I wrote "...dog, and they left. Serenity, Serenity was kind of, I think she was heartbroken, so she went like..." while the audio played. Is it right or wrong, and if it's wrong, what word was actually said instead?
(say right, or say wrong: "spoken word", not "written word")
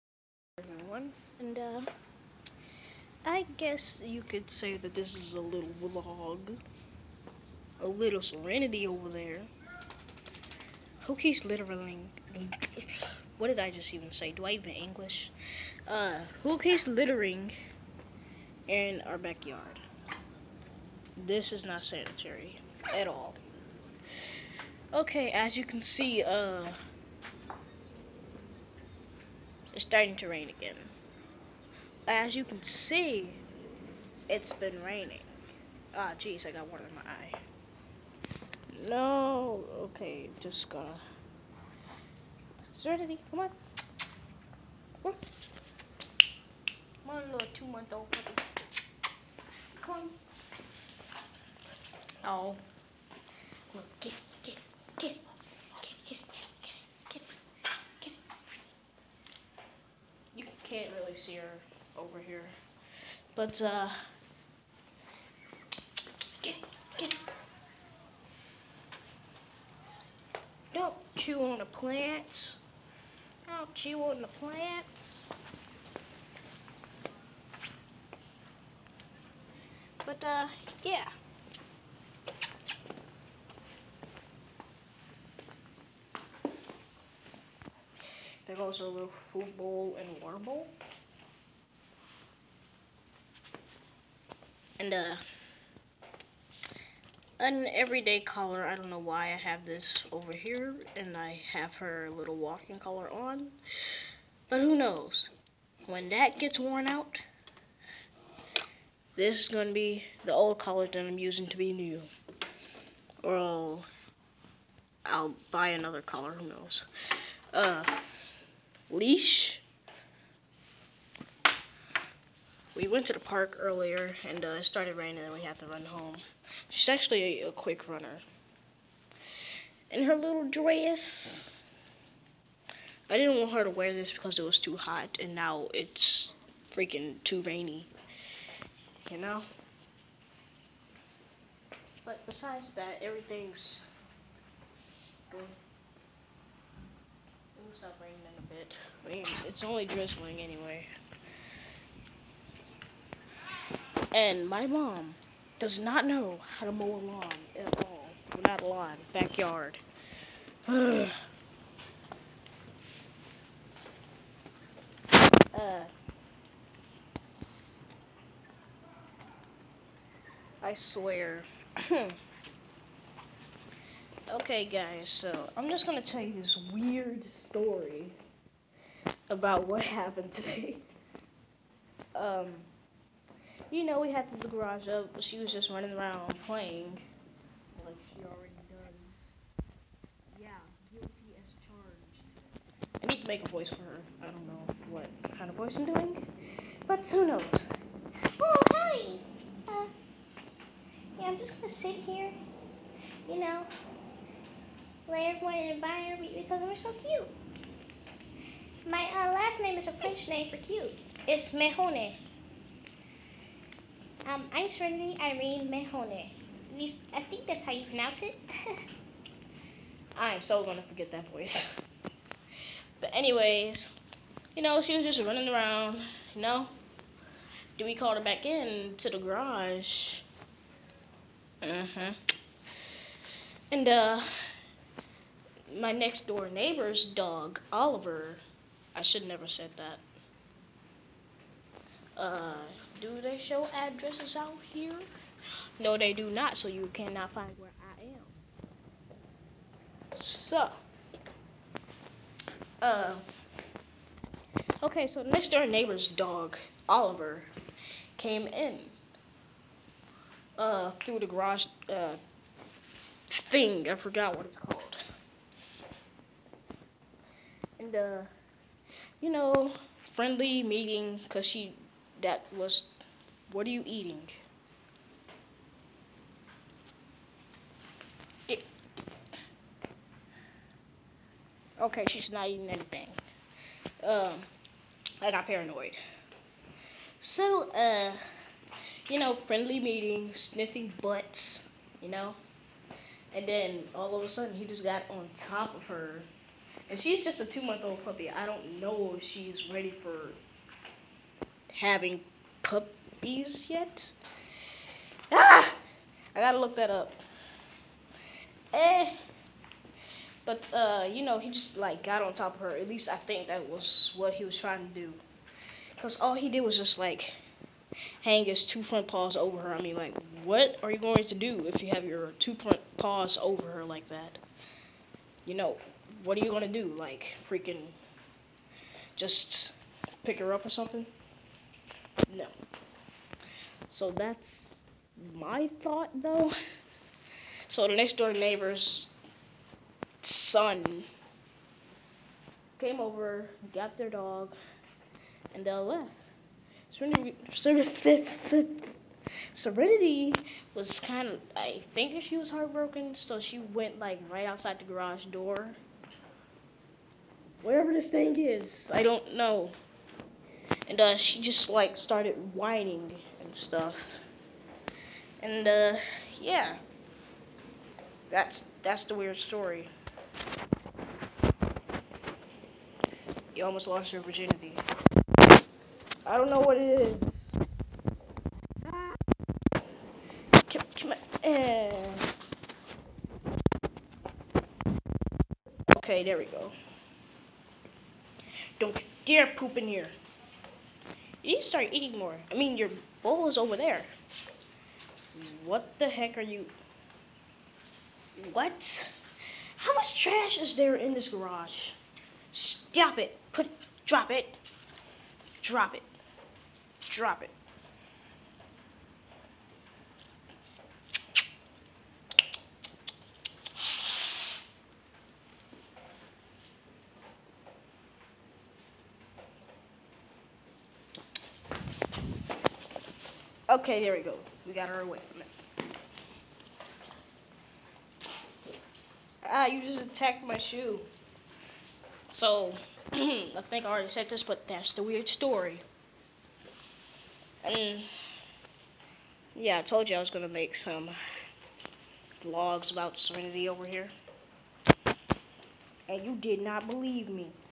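right.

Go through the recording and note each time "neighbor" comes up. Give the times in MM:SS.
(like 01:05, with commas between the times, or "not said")
03:56, 04:15, 05:38.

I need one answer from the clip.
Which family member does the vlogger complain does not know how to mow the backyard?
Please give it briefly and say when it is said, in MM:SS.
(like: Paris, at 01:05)
mom, at 02:34.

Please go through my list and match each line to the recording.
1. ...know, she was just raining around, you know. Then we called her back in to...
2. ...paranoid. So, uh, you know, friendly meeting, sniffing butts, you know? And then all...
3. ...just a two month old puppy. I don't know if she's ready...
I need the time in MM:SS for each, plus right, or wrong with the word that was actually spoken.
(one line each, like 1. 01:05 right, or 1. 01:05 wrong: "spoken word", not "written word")
1. 03:44 wrong: "running", not "raining"
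2. 04:45 right
3. 04:57 right.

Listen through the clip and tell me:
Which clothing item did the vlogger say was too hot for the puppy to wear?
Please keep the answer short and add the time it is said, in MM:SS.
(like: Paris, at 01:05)
dress, at 02:10.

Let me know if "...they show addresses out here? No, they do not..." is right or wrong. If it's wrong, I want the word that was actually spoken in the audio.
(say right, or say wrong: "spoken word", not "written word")
right.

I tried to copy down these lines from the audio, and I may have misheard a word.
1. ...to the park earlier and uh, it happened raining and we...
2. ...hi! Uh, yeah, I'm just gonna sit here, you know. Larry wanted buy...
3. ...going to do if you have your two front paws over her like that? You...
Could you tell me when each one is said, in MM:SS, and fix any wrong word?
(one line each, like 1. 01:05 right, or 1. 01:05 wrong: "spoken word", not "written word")
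1. 02:03 wrong: "started", not "happened"
2. 03:18 right
3. 05:20 right.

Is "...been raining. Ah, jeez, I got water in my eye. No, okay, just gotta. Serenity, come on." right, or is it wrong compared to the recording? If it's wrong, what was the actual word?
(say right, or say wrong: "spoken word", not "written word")
right.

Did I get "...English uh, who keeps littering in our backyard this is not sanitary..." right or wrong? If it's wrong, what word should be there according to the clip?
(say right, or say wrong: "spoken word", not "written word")
right.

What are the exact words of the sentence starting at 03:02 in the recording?
um, you know, we had the garage up, she was just running around playing, like she already does.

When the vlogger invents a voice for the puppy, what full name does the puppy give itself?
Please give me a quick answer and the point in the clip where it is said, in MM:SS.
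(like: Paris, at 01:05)
Trinity Irene Mejone, at 03:34.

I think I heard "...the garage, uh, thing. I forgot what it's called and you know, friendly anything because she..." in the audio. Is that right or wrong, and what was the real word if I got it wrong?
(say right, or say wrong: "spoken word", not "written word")
wrong: "meeting", not "anything".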